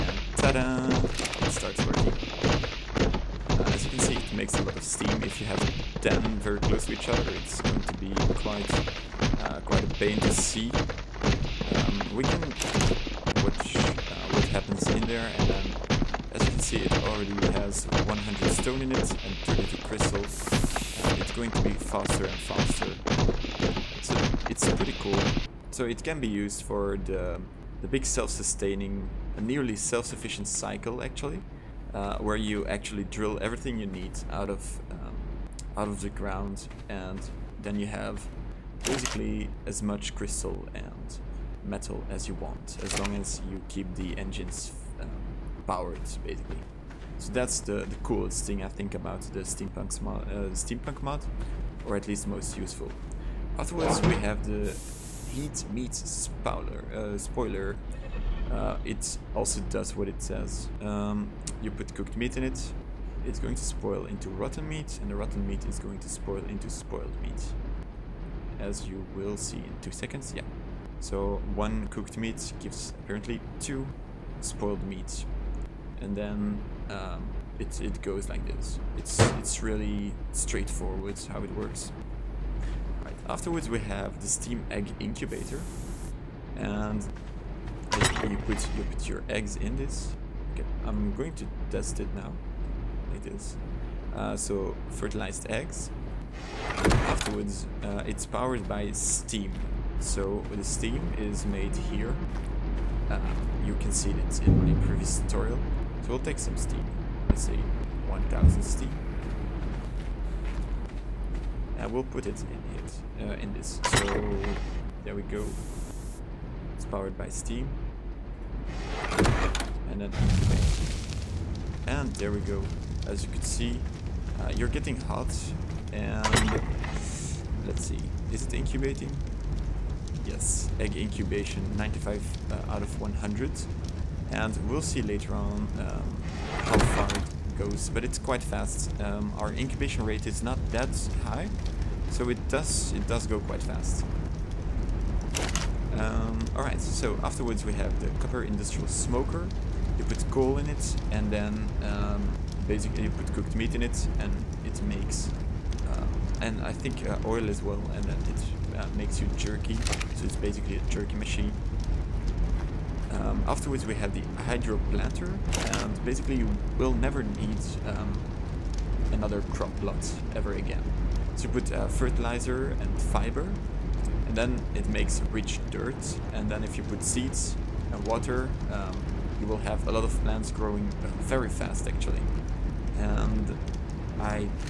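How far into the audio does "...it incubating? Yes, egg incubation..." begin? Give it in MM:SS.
02:08.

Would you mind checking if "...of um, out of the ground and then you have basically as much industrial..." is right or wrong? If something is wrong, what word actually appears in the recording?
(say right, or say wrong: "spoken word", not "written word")
wrong: "crystal", not "industrial".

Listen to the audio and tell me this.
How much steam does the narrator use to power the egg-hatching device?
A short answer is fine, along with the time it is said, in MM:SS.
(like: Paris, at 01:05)
1000, at 01:48.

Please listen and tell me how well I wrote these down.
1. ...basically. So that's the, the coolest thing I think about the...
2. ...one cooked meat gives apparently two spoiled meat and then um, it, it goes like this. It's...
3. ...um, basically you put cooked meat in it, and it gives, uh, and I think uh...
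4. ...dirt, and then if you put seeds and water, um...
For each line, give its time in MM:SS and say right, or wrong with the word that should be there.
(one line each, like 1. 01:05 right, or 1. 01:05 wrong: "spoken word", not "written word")
1. 00:46 right
2. 01:11 right
3. 02:31 wrong: "makes", not "gives"
4. 02:55 right.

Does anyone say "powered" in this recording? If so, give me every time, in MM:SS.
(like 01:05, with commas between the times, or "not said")
01:38, 01:56.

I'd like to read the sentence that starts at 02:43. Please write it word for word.
Um, afterwards we have the hydro planter, and basically you will never need um, another crop plot ever again.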